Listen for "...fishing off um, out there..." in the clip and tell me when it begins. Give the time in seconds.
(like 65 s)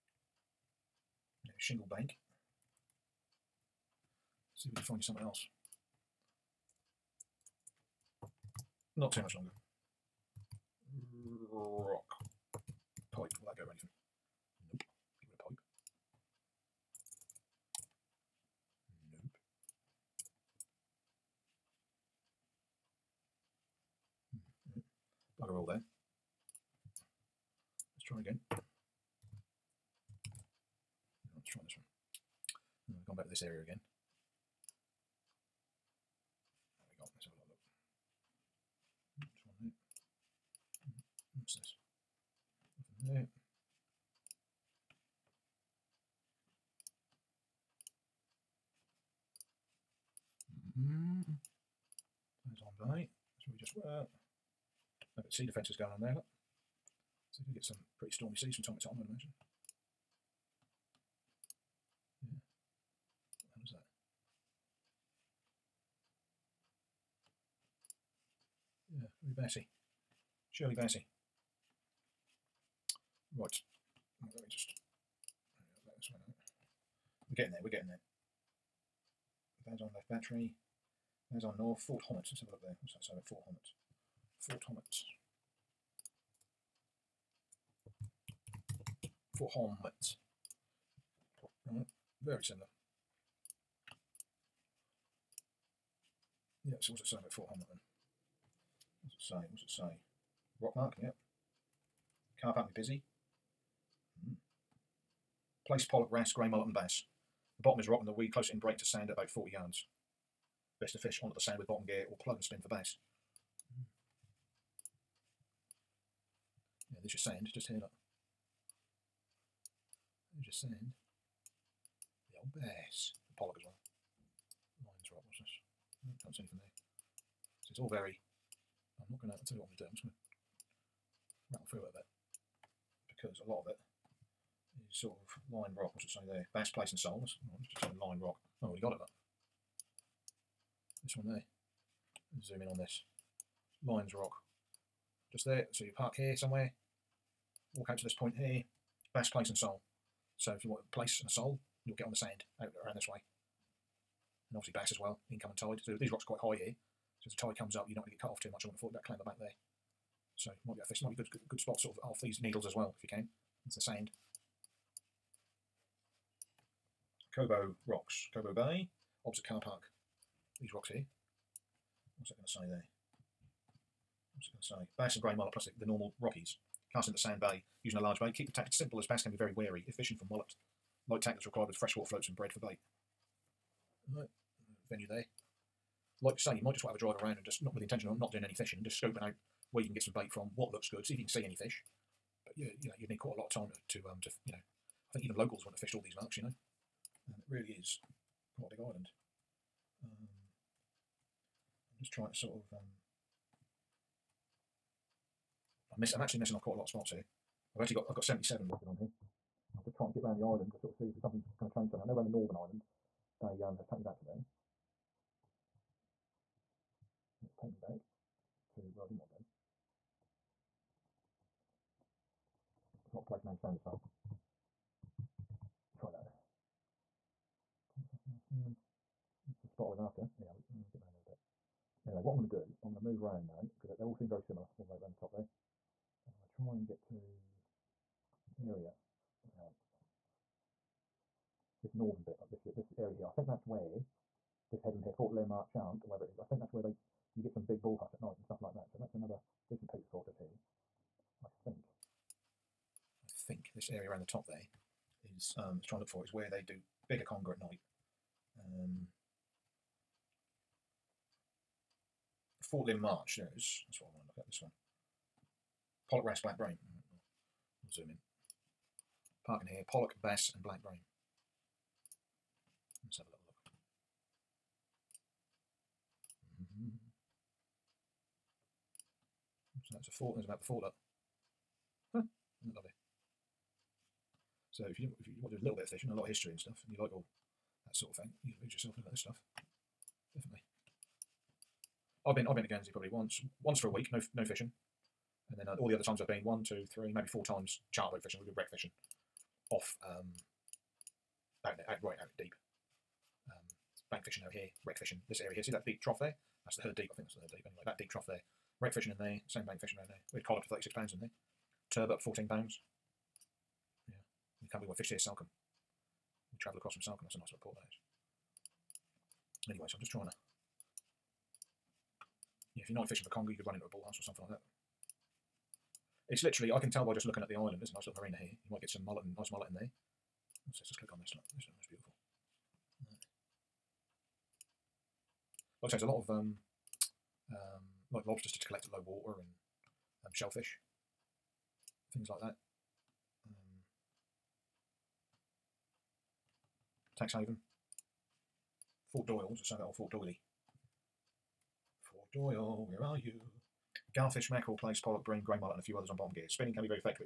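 298 s.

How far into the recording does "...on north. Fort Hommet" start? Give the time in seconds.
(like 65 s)
81 s.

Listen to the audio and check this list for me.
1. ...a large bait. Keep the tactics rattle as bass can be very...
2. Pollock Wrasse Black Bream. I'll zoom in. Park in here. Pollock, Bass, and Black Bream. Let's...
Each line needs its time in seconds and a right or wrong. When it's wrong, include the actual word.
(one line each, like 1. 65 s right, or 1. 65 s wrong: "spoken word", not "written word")
1. 177 s wrong: "simple", not "rattle"
2. 266 s right.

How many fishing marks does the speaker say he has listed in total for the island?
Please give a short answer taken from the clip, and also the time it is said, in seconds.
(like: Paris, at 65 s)
77, at 208 s.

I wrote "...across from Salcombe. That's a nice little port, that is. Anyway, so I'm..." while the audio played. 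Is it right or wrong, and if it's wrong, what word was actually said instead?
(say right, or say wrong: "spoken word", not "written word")
right.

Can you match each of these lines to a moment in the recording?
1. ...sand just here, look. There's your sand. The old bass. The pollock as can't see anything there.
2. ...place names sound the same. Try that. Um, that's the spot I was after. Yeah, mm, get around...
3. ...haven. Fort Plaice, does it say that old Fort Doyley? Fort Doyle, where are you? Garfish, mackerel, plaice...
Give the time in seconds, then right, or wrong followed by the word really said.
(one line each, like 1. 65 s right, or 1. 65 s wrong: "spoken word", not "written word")
1. 117 s right
2. 223 s right
3. 347 s wrong: "Doyle", not "Plaice".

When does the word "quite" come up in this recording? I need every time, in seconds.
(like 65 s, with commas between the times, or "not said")
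156 s, 193 s, 198 s, 206 s.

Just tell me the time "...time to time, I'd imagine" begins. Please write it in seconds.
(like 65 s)
58 s.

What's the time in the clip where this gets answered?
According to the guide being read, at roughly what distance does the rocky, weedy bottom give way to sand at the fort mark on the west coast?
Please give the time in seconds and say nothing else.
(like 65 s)
109 s.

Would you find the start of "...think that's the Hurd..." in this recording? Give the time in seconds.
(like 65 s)
307 s.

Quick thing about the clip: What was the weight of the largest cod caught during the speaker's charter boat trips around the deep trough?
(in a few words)
36 pounds.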